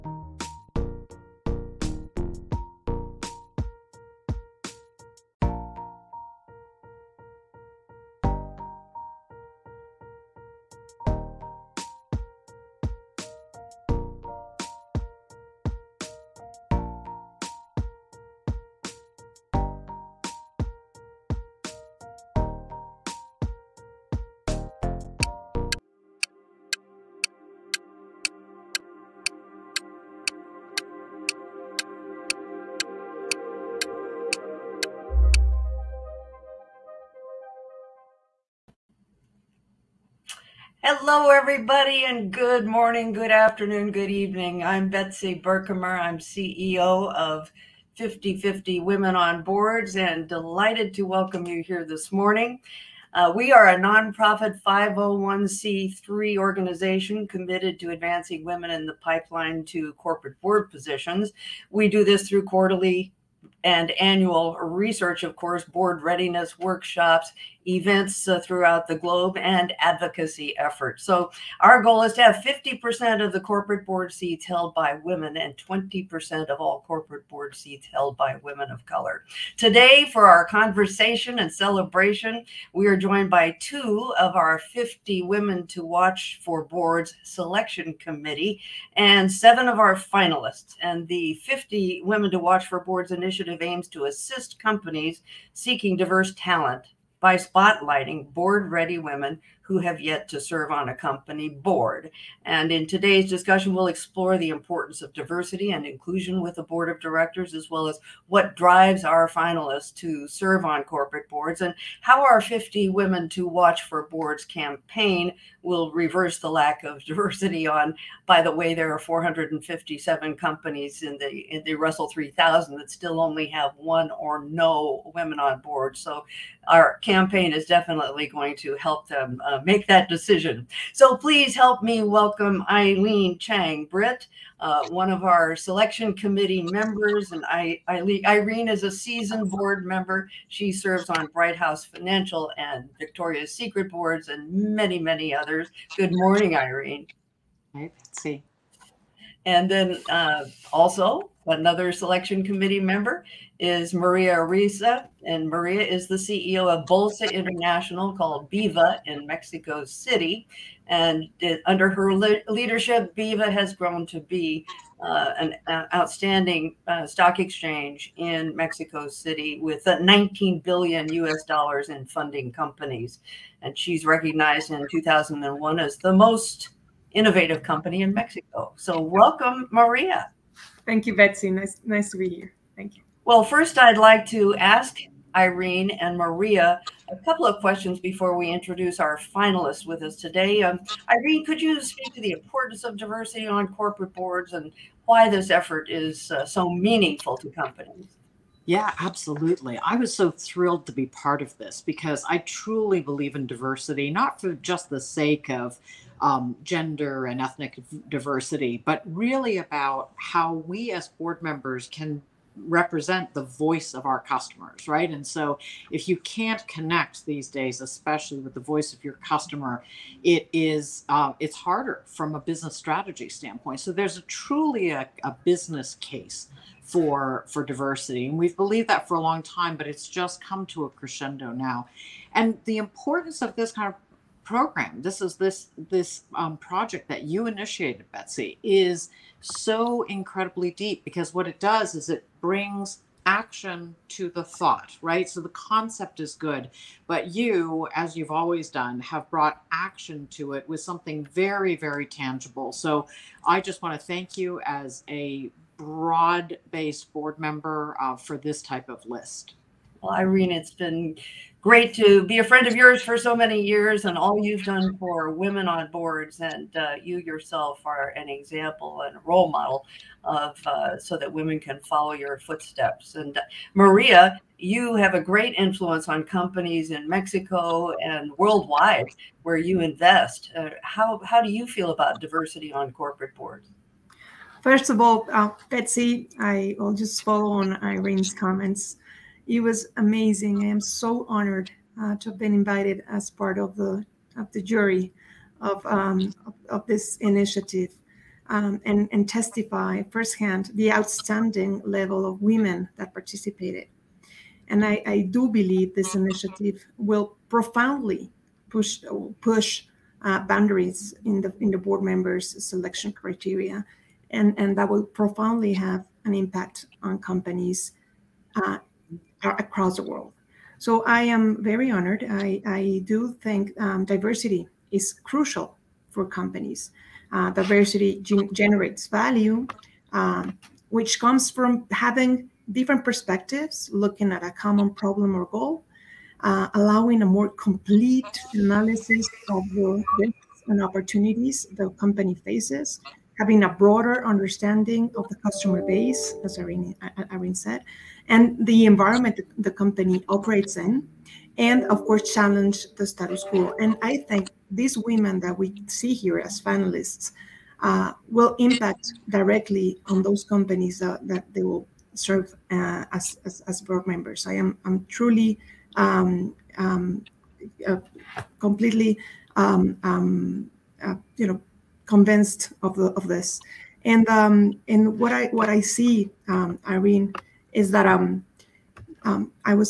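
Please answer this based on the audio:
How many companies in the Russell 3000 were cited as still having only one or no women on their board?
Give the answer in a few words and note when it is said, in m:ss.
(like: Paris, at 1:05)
457, at 1:58.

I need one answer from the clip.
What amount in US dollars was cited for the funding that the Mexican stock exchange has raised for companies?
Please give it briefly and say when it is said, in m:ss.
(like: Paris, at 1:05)
19 billion, at 2:49.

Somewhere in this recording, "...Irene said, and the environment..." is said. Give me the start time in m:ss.
5:47.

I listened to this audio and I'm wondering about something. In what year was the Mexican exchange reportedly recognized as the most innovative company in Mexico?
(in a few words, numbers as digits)
2001.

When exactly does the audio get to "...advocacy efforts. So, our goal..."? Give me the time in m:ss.
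1:09.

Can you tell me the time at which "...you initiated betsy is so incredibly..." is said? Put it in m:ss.
3:57.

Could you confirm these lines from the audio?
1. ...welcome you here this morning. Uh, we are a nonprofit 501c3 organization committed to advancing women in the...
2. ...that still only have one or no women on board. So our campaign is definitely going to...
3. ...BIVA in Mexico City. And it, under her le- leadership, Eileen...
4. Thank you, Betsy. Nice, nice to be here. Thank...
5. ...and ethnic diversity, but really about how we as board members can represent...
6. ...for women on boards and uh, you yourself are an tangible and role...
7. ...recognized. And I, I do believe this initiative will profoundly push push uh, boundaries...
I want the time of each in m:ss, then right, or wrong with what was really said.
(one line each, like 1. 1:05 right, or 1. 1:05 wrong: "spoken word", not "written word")
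1. 0:51 right
2. 2:02 right
3. 2:38 wrong: "BIVA", not "Eileen"
4. 3:00 right
5. 3:27 right
6. 4:24 wrong: "example", not "tangible"
7. 5:03 wrong: "participated", not "recognized".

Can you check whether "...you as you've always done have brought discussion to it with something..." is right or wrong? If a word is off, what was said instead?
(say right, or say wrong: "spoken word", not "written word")
wrong: "action", not "discussion".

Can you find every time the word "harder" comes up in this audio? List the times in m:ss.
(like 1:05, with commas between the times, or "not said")
3:41.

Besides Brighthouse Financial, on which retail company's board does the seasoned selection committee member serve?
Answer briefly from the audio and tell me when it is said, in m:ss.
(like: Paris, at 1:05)
Victoria's Secret, at 2:22.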